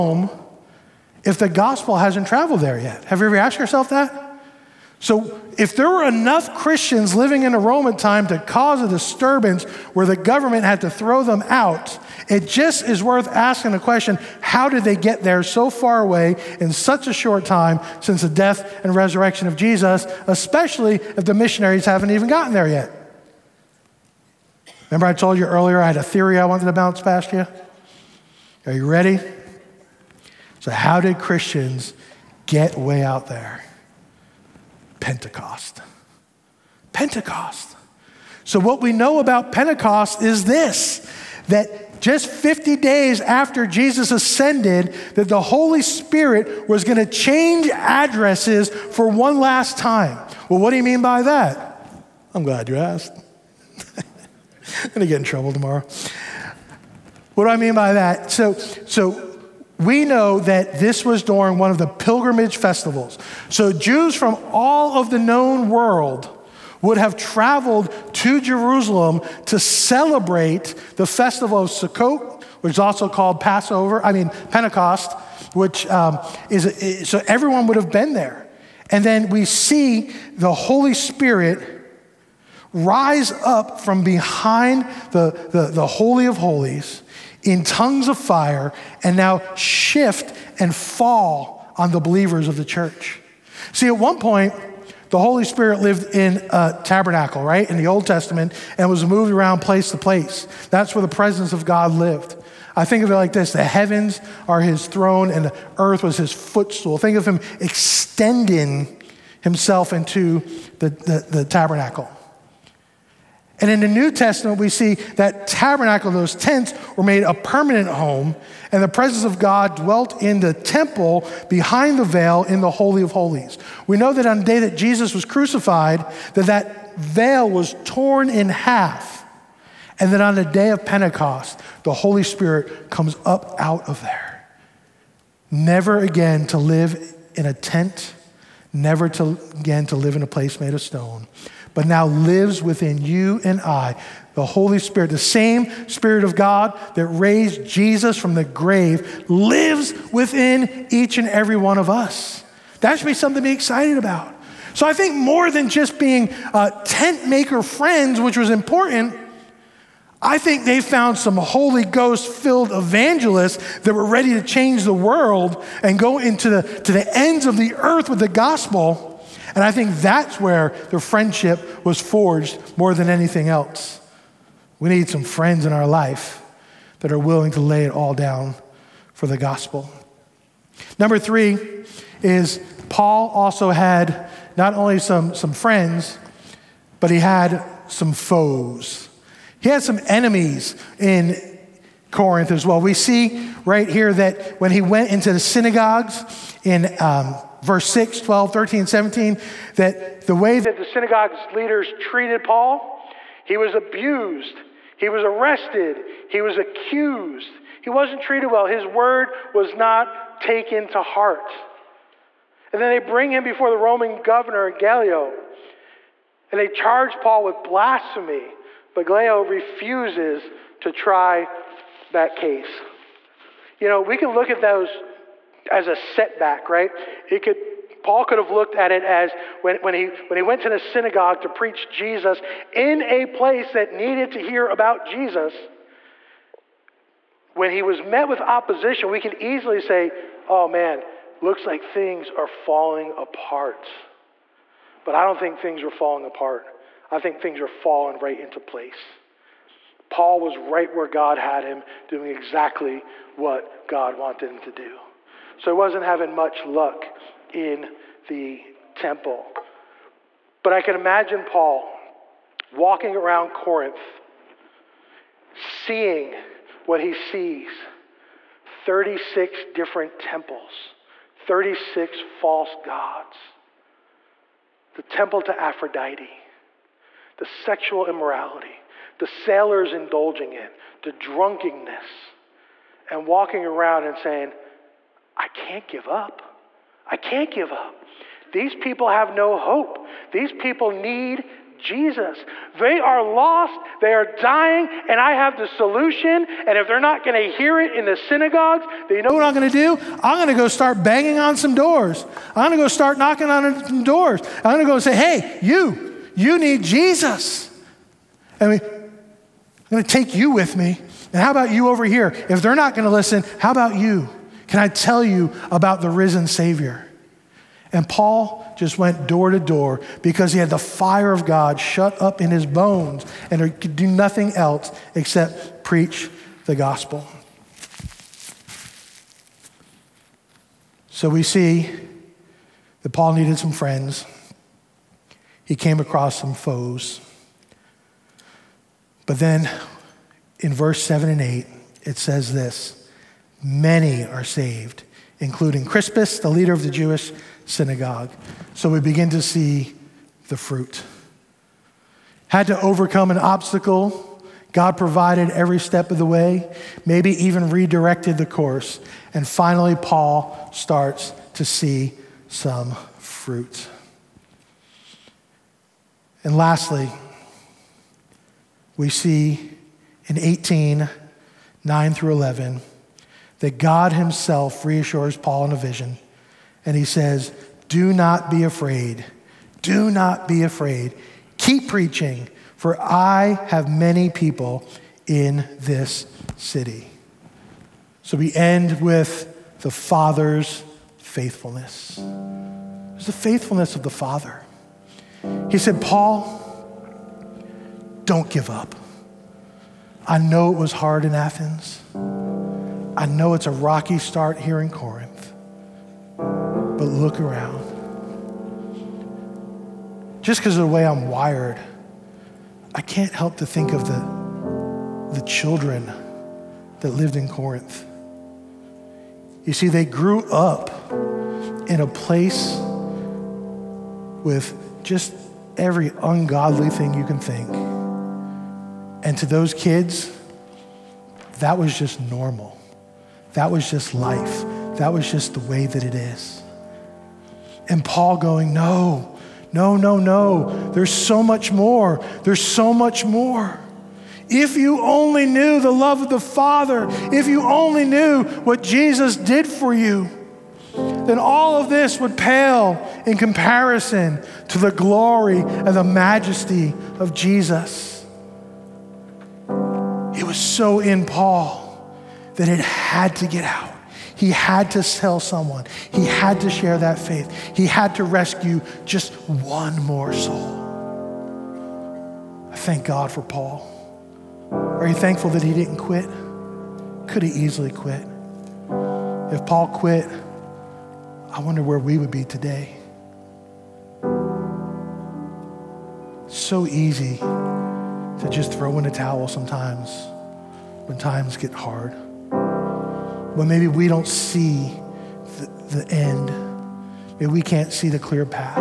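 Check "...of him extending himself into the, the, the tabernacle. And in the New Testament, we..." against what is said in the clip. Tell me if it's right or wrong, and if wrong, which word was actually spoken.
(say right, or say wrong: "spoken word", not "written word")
right.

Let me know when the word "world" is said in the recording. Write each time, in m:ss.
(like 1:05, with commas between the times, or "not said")
1:05, 2:44.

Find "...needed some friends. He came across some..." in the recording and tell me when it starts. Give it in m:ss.
5:33.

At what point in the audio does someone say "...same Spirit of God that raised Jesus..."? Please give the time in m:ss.
2:25.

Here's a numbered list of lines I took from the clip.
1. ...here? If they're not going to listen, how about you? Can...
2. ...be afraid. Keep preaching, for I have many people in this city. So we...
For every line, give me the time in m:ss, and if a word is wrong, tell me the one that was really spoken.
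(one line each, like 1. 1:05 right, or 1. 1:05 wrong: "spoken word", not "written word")
1. 5:12 right
2. 6:20 right.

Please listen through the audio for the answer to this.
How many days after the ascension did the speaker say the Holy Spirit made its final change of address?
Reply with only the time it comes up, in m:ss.
0:42.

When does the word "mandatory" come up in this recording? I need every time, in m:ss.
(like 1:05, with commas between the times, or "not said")
not said.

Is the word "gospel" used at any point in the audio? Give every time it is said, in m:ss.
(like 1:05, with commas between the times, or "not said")
0:01, 2:48, 2:59, 5:26.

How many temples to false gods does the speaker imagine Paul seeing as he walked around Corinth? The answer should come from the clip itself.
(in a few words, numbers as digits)
36.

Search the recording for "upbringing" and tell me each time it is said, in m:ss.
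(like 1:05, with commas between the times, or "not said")
not said.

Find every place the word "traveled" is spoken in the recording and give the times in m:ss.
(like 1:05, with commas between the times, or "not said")
0:02, 1:07.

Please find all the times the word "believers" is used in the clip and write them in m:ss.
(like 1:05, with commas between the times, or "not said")
1:31.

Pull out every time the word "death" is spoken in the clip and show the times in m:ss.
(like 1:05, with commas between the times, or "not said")
0:18.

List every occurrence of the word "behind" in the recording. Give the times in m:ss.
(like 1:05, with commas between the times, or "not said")
1:24, 2:01.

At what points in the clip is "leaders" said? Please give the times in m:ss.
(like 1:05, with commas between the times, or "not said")
3:21, 5:46.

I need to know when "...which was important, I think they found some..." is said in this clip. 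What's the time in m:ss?
2:38.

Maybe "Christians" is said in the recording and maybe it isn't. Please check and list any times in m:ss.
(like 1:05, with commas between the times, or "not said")
0:06, 0:31.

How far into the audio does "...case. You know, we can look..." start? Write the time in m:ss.
3:42.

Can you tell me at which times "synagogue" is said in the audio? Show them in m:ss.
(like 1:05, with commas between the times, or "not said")
3:15, 3:20, 3:50, 4:58, 5:47.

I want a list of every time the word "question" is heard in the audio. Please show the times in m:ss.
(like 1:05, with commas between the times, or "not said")
0:13.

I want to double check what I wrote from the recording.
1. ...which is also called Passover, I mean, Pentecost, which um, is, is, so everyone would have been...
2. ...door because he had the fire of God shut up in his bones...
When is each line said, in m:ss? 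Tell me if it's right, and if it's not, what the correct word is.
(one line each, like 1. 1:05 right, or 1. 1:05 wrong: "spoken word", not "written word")
1. 1:12 right
2. 5:19 right.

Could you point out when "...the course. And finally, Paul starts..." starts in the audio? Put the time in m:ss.
5:58.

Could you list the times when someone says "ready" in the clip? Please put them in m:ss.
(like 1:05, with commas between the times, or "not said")
0:28, 2:44.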